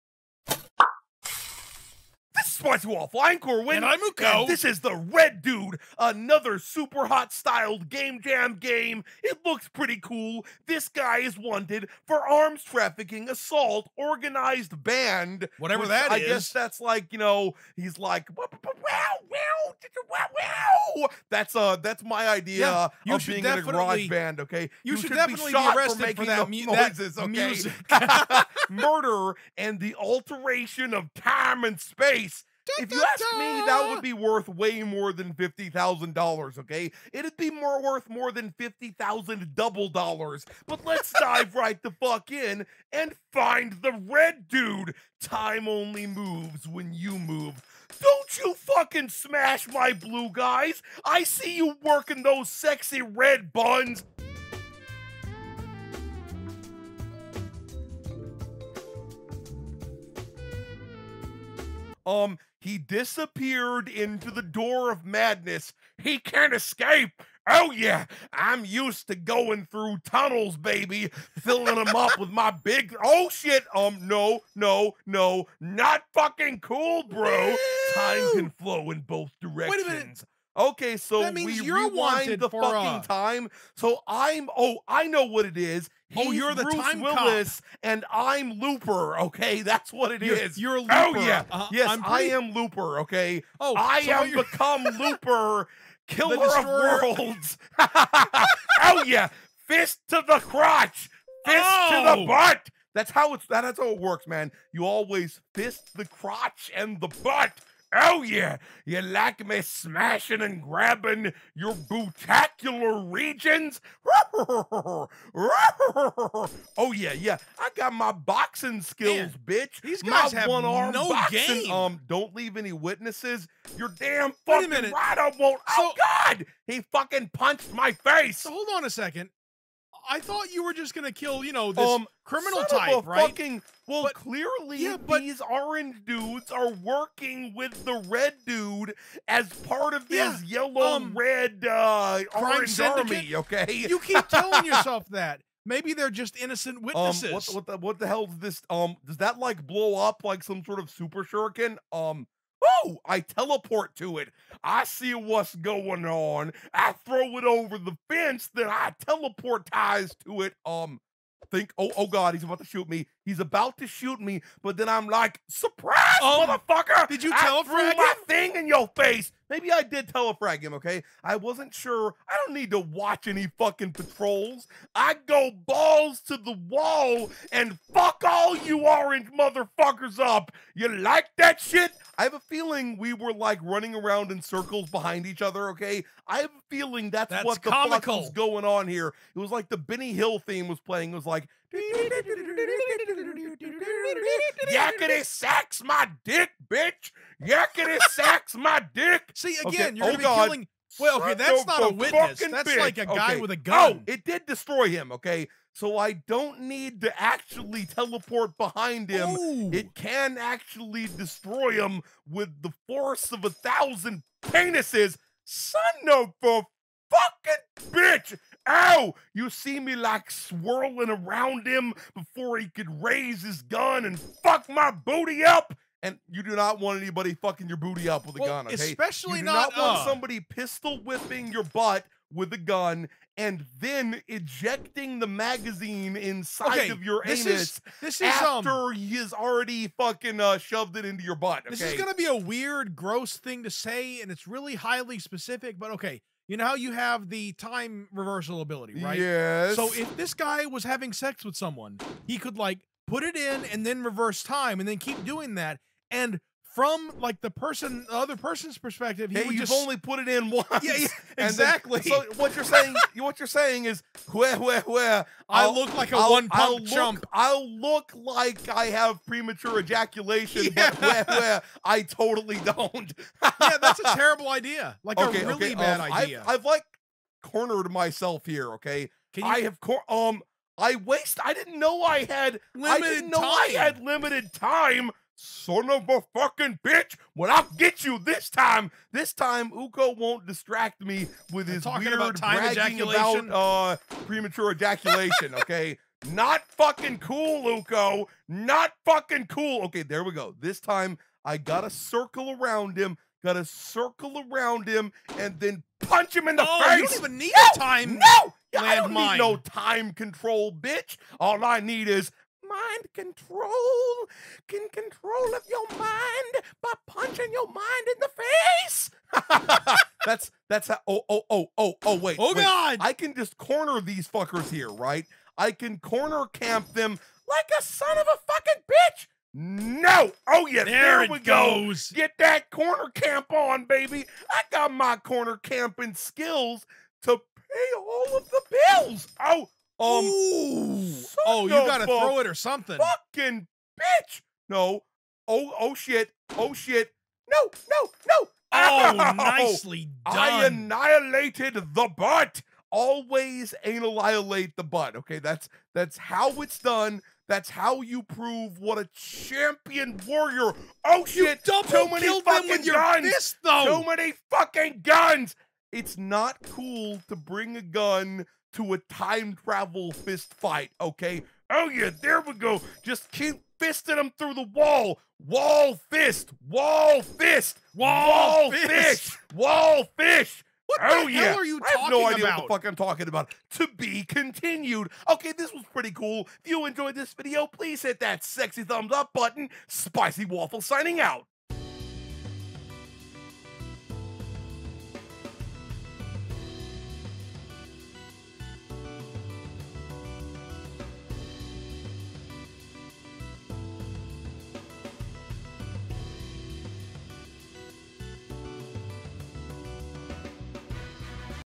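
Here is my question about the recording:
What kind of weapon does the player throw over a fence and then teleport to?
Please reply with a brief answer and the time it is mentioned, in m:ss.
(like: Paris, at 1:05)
Super shuriken, at 2:30.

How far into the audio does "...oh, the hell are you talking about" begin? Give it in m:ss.
6:21.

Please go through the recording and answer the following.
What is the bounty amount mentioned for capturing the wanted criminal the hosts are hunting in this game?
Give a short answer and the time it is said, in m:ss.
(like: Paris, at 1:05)
$50,000, at 0:35.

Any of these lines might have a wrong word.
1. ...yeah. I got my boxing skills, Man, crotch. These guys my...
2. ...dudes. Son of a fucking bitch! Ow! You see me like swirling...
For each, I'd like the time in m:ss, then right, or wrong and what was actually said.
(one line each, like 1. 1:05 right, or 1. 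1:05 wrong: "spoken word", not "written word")
1. 1:57 wrong: "bitch", not "crotch"
2. 3:34 wrong: "penises", not "dudes".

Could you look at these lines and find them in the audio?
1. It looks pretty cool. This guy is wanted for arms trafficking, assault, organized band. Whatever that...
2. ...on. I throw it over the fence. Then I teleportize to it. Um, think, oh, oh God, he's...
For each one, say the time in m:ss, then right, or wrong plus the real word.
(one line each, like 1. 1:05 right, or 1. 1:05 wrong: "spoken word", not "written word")
1. 0:09 right
2. 2:36 right.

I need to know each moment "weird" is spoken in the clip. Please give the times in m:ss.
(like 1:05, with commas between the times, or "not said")
4:02, 4:51.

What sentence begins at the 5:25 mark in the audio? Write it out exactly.
I can corner camp them like a son of a fucking bitch.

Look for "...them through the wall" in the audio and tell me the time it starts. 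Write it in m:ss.
6:14.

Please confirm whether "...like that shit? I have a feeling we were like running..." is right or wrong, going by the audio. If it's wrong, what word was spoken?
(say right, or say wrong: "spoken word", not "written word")
right.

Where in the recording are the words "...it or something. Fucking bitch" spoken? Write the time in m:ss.
5:42.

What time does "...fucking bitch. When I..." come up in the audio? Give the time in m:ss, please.
4:46.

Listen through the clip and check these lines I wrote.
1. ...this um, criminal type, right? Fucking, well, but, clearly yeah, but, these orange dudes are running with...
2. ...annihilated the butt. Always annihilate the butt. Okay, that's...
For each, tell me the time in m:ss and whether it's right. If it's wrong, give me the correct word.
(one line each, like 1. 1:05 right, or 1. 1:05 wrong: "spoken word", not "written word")
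1. 2:11 wrong: "working", not "running"
2. 5:50 right.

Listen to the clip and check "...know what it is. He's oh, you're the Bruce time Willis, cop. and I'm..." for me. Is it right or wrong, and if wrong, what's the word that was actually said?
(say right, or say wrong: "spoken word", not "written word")
right.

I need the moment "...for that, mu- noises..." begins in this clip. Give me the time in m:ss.
0:26.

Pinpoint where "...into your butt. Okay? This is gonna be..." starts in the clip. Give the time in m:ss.
4:01.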